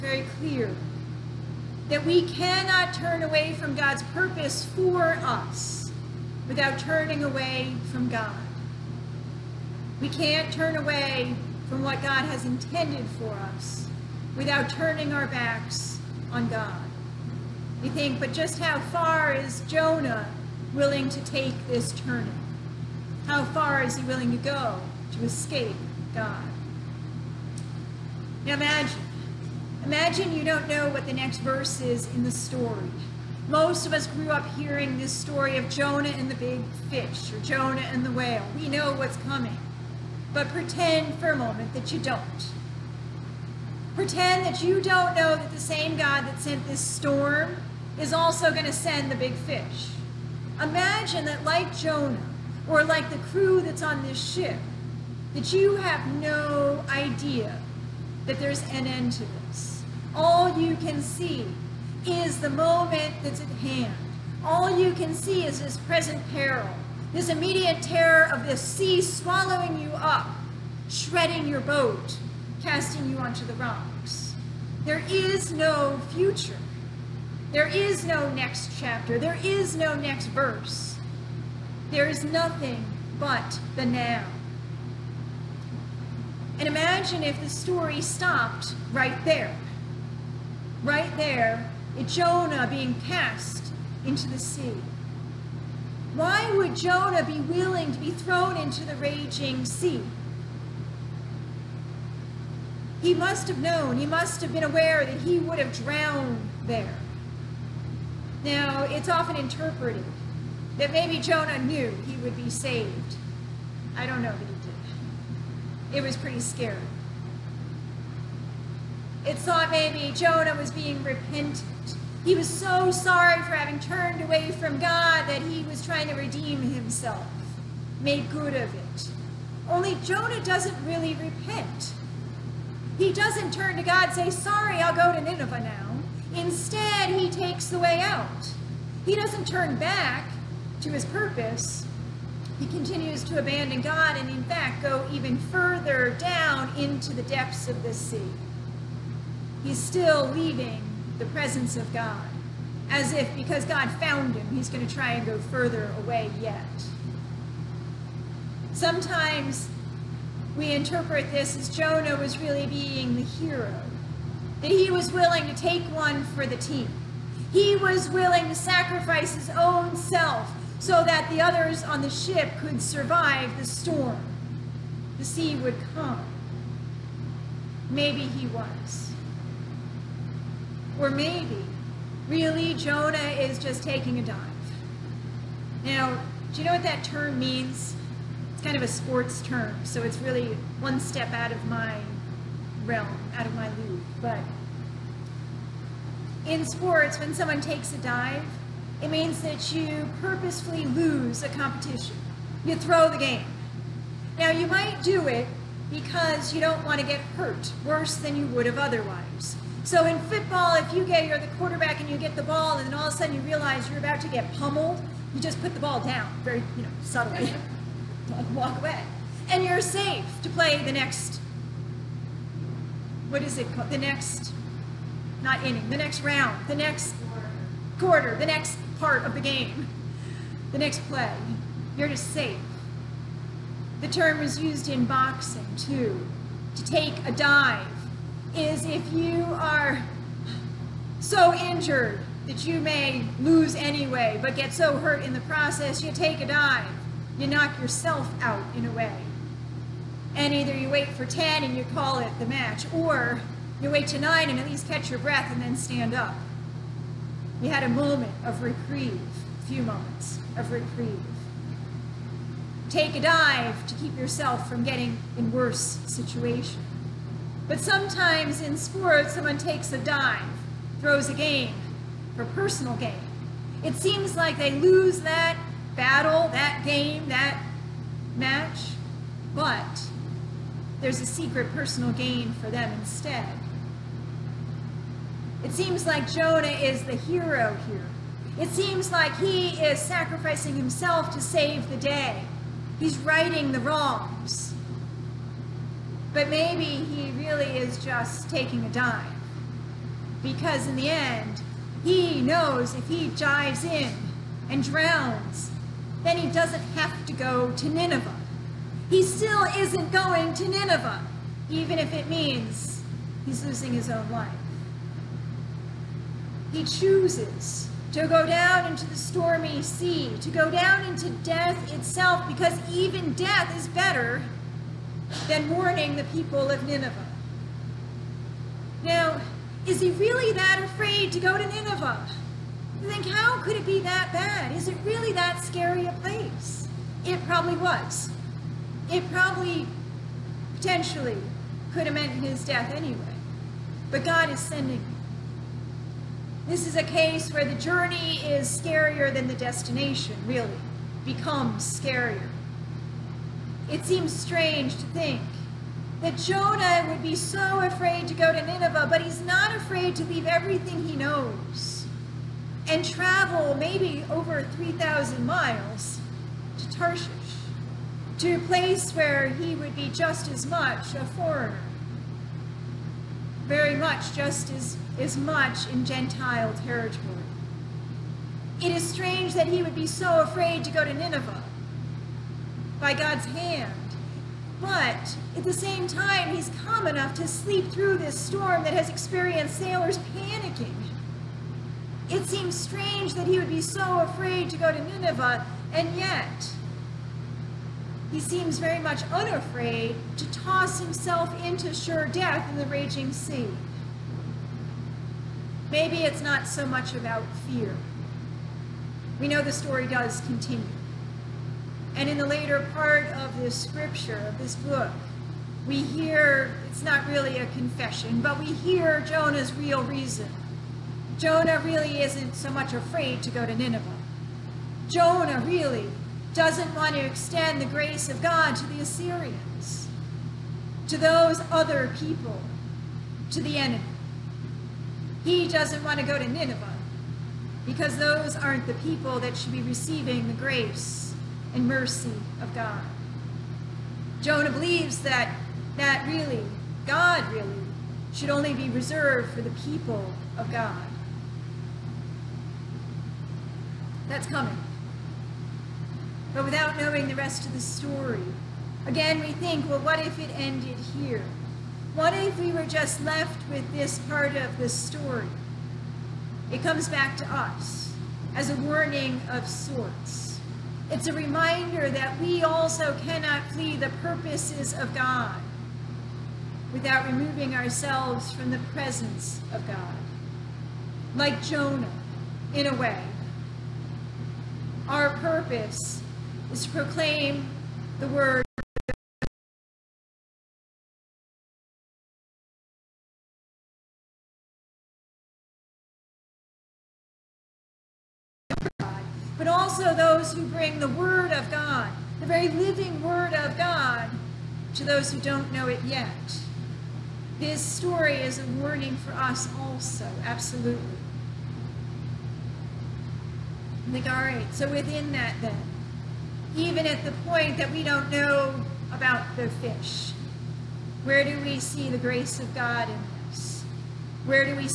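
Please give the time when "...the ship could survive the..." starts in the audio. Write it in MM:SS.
02:52.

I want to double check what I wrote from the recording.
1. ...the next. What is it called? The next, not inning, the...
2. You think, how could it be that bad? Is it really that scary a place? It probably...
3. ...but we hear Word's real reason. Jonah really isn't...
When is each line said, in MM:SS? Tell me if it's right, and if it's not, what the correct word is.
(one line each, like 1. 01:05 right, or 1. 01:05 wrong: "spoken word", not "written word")
1. 03:40 right
2. 05:33 right
3. 06:58 wrong: "Jonah", not "Word".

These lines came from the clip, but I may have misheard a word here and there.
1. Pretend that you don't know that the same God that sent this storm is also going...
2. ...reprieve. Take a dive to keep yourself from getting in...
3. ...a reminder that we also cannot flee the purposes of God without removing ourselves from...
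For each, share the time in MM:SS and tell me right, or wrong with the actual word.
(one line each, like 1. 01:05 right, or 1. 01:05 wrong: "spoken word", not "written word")
1. 00:43 right
2. 04:20 right
3. 07:51 right.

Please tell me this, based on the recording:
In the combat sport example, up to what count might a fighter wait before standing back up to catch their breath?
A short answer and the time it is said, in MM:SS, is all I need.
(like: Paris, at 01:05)
9, at 04:14.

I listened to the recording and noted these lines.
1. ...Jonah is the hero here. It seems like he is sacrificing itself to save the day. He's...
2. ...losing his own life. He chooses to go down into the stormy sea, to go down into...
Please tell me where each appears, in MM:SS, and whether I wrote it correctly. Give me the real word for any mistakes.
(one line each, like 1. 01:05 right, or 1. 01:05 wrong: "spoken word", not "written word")
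1. 04:46 wrong: "himself", not "itself"
2. 05:13 right.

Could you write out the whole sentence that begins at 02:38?
Sometimes we interpret this as Jonah was really being the hero, that he was willing to take one for the team.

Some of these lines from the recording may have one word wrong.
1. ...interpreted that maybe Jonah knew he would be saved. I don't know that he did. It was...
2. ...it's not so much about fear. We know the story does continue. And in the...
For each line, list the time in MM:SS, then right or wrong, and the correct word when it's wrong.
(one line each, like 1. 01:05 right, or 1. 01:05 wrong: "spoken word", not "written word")
1. 01:49 right
2. 06:46 right.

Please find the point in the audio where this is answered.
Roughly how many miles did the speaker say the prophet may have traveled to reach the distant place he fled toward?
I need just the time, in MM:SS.
06:04.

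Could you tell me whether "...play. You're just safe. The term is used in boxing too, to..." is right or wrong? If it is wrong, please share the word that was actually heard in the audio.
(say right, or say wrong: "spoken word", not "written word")
right.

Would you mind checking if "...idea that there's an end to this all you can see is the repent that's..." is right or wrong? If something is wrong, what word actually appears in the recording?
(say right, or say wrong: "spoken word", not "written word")
wrong: "moment", not "repent".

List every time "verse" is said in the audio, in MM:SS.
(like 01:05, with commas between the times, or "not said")
00:31, 01:20.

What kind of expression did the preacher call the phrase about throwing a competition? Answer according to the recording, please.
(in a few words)
a sports term.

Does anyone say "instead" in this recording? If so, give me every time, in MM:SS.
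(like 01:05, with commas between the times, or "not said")
02:16, 04:42.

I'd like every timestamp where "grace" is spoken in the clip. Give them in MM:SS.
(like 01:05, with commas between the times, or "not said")
07:07, 07:20, 08:42.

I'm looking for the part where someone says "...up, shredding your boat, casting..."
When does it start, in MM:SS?
01:09.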